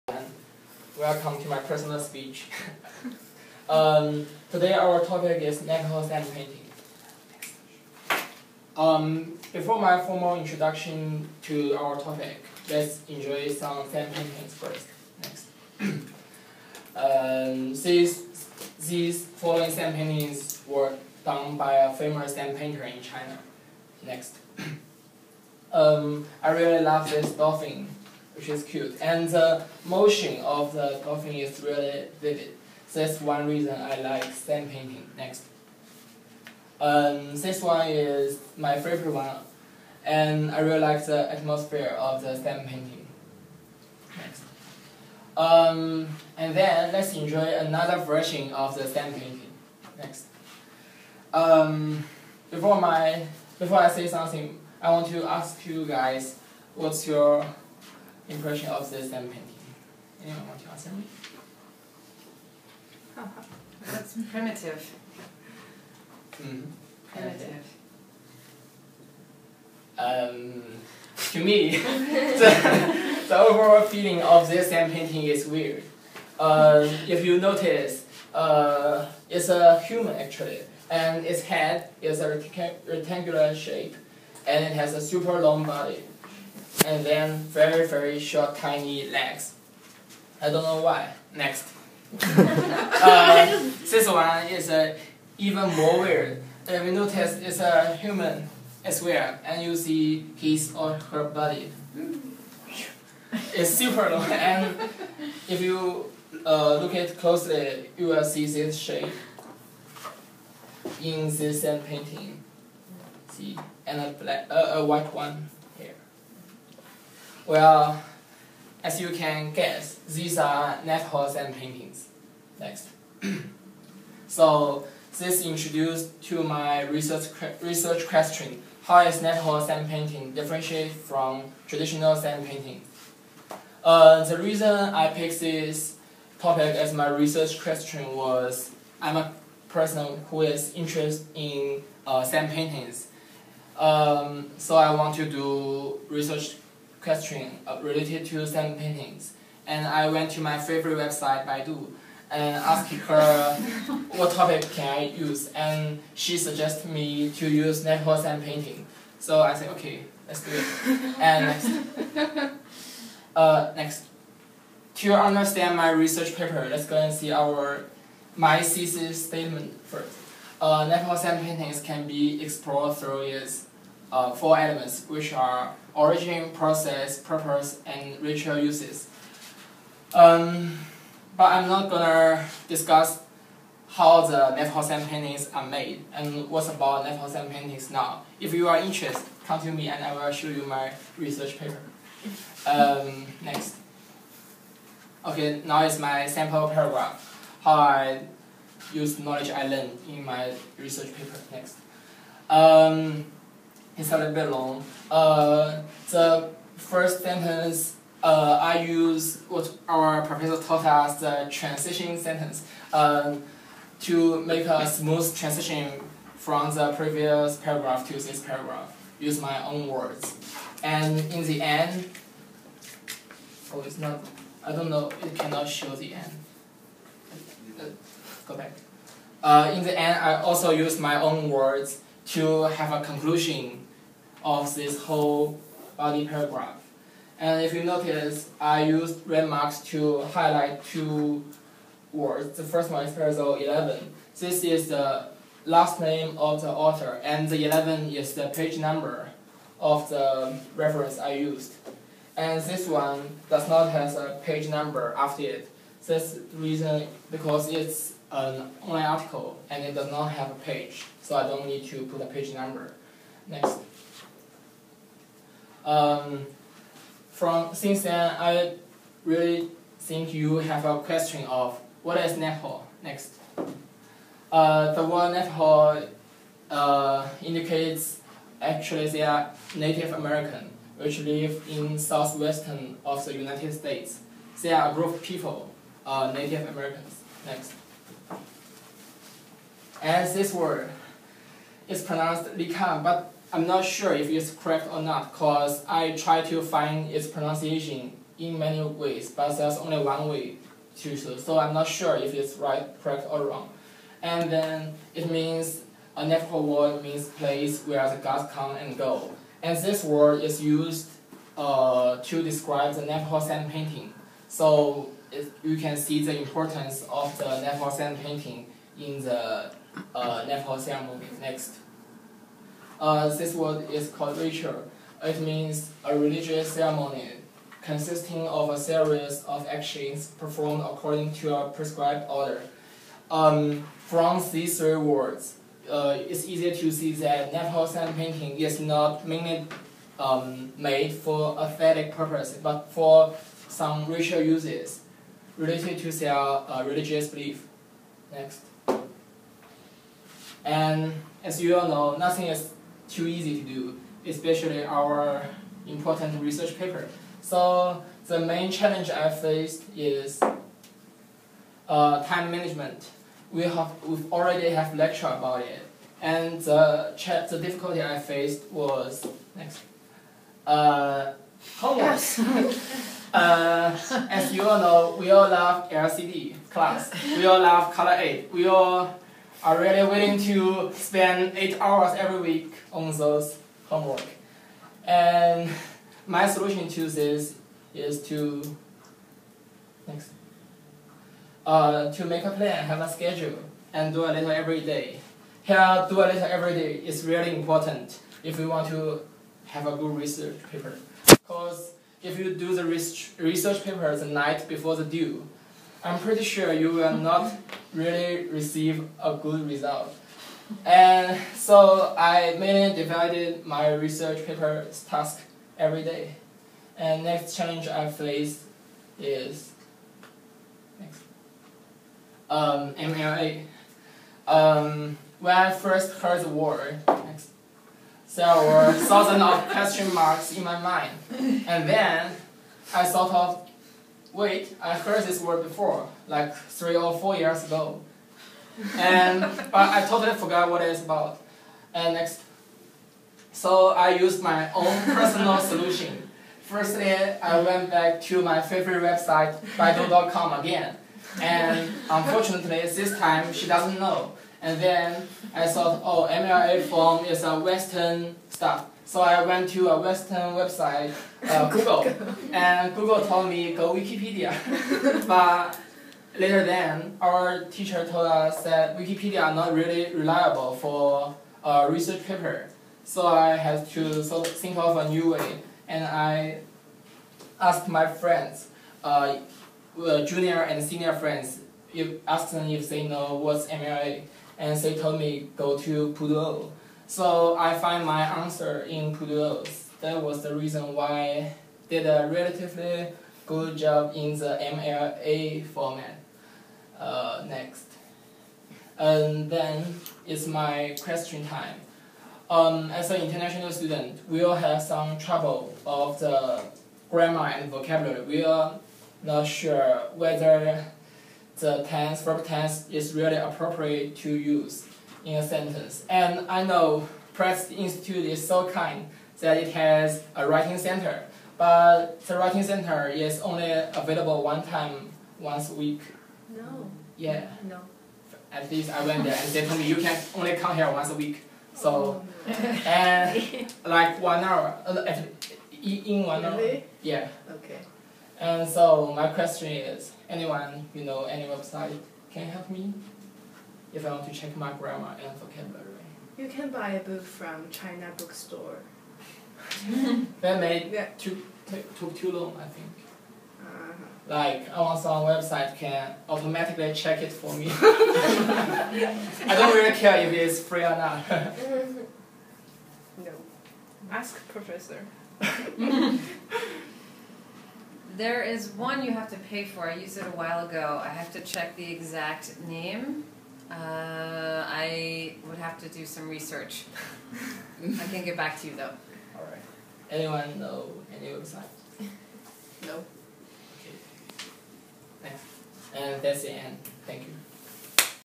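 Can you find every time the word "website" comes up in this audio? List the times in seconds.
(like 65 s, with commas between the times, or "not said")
150 s, 449 s, 460 s, 541 s, 555 s, 581 s.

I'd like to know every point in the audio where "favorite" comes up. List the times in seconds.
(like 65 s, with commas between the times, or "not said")
38 s, 150 s, 448 s.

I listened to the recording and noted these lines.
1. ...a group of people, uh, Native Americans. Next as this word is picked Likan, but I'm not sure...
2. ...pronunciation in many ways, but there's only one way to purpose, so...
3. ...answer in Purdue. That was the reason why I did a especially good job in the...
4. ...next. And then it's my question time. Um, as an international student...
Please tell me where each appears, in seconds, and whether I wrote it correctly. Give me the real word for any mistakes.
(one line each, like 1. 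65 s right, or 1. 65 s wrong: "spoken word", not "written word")
1. 284 s wrong: "pronounced", not "picked"
2. 297 s wrong: "choose", not "purpose"
3. 488 s wrong: "relatively", not "especially"
4. 497 s right.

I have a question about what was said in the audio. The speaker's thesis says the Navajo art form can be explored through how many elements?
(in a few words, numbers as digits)
4.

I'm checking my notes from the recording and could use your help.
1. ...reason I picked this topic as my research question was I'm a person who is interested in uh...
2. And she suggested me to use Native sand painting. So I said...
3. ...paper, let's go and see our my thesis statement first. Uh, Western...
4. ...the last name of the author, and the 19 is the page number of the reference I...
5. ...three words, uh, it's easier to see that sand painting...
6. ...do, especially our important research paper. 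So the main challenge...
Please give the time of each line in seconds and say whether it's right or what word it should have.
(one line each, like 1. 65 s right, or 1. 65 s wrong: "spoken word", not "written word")
1. 134 s right
2. 155 s wrong: "Navajo", not "Native"
3. 166 s wrong: "Navajo", not "Western"
4. 244 s wrong: "11", not "19"
5. 334 s right
6. 353 s right.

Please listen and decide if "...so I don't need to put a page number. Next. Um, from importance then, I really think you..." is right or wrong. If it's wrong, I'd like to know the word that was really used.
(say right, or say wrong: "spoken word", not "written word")
wrong: "since", not "importance".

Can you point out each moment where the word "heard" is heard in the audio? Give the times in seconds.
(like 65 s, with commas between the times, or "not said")
426 s, 434 s.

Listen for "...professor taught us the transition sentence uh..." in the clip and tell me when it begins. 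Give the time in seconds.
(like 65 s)
210 s.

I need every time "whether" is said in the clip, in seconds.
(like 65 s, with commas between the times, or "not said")
510 s.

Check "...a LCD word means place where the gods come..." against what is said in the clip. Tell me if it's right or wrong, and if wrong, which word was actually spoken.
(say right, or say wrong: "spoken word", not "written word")
wrong: "Navajo", not "LCD".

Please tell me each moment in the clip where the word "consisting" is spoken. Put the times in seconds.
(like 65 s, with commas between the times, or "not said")
327 s.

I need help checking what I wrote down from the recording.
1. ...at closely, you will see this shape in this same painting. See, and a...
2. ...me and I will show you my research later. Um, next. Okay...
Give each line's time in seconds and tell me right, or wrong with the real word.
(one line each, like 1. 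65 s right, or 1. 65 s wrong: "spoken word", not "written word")
1. 106 s right
2. 189 s wrong: "paper", not "later".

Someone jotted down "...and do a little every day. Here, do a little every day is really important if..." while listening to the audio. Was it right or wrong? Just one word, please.
right.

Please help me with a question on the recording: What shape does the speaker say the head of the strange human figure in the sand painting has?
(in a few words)
rectangular.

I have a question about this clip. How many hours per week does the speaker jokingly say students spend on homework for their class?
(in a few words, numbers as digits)
8.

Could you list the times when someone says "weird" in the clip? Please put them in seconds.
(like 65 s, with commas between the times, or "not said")
75 s, 96 s.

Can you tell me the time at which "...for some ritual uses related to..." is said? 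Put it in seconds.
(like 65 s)
342 s.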